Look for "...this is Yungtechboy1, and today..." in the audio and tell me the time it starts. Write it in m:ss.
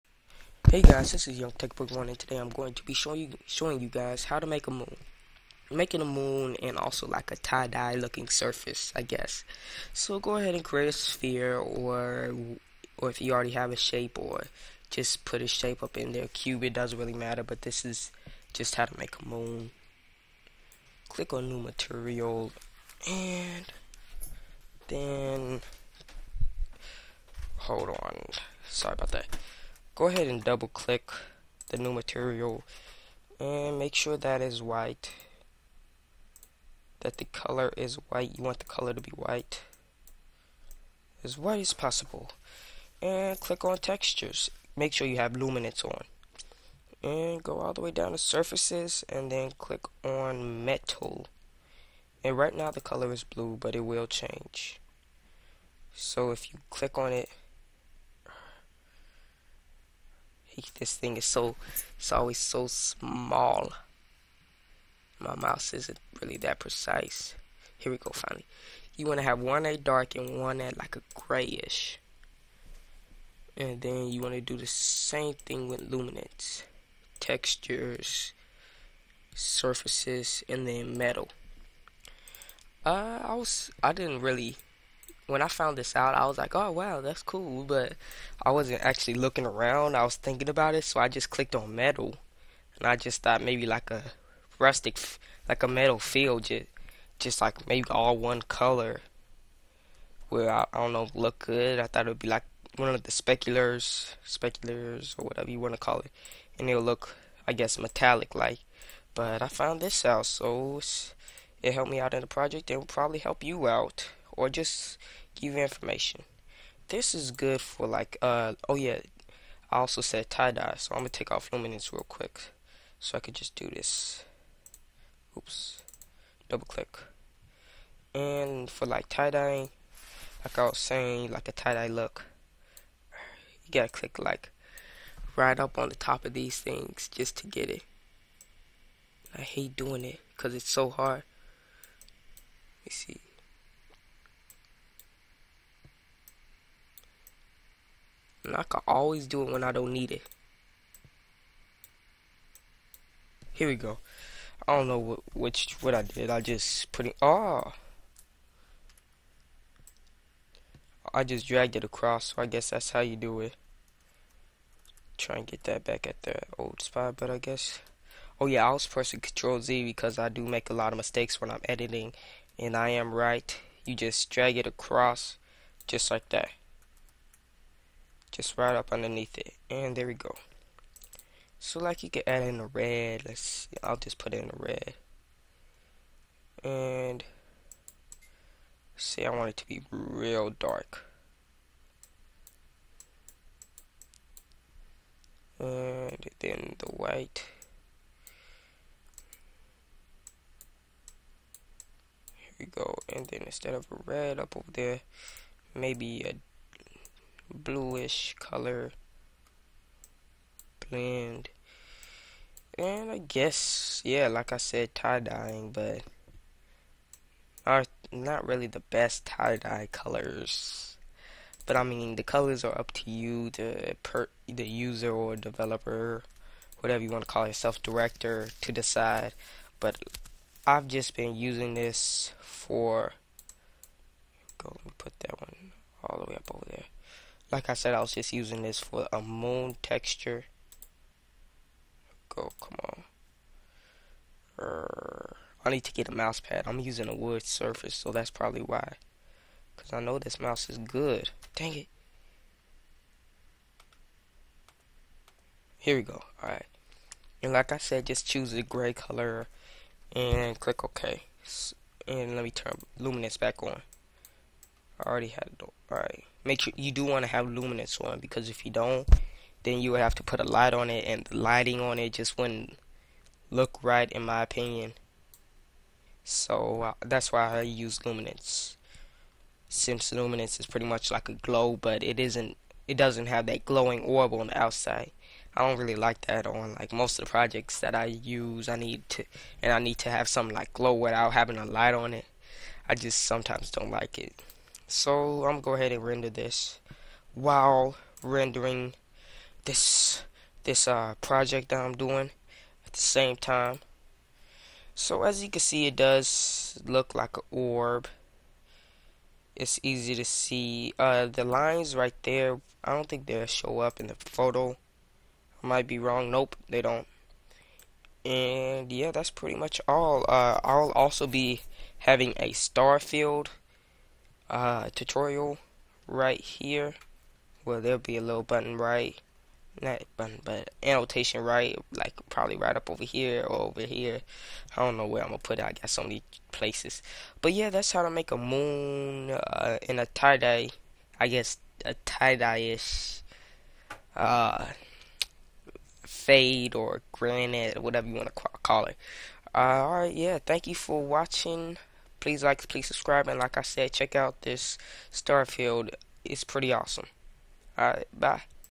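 0:01.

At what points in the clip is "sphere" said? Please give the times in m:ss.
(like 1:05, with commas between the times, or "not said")
0:10.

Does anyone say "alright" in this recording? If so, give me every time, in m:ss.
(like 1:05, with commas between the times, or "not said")
4:16, 4:25, 5:49, 5:57.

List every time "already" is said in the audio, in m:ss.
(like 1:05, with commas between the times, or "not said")
0:13, 4:25.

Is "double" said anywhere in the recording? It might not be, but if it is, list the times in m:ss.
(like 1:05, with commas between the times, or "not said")
0:30, 2:06.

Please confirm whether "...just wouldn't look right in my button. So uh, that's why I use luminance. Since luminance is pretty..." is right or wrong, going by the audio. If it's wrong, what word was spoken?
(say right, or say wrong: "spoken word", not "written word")
wrong: "opinion", not "button".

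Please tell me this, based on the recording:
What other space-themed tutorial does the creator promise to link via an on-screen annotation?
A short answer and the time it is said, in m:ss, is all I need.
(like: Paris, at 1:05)
Star field, at 5:22.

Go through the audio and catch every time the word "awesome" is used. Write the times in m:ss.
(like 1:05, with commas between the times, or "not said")
5:56.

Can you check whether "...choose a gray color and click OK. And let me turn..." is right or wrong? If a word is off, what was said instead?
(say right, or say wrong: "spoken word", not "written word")
right.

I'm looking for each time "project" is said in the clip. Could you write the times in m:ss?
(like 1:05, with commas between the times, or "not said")
1:52, 4:47, 5:01.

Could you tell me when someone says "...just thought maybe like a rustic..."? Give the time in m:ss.
1:32.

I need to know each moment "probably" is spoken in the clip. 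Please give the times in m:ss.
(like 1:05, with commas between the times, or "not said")
1:52, 4:08, 5:32.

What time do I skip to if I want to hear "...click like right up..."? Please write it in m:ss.
2:13.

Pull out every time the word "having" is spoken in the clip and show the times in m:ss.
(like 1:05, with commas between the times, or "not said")
4:51, 5:21.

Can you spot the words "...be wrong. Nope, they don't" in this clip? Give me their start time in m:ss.
5:15.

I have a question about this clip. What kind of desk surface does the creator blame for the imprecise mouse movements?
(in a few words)
A wood surface.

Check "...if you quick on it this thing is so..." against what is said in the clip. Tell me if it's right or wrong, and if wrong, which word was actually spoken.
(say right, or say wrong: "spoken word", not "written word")
wrong: "click", not "quick".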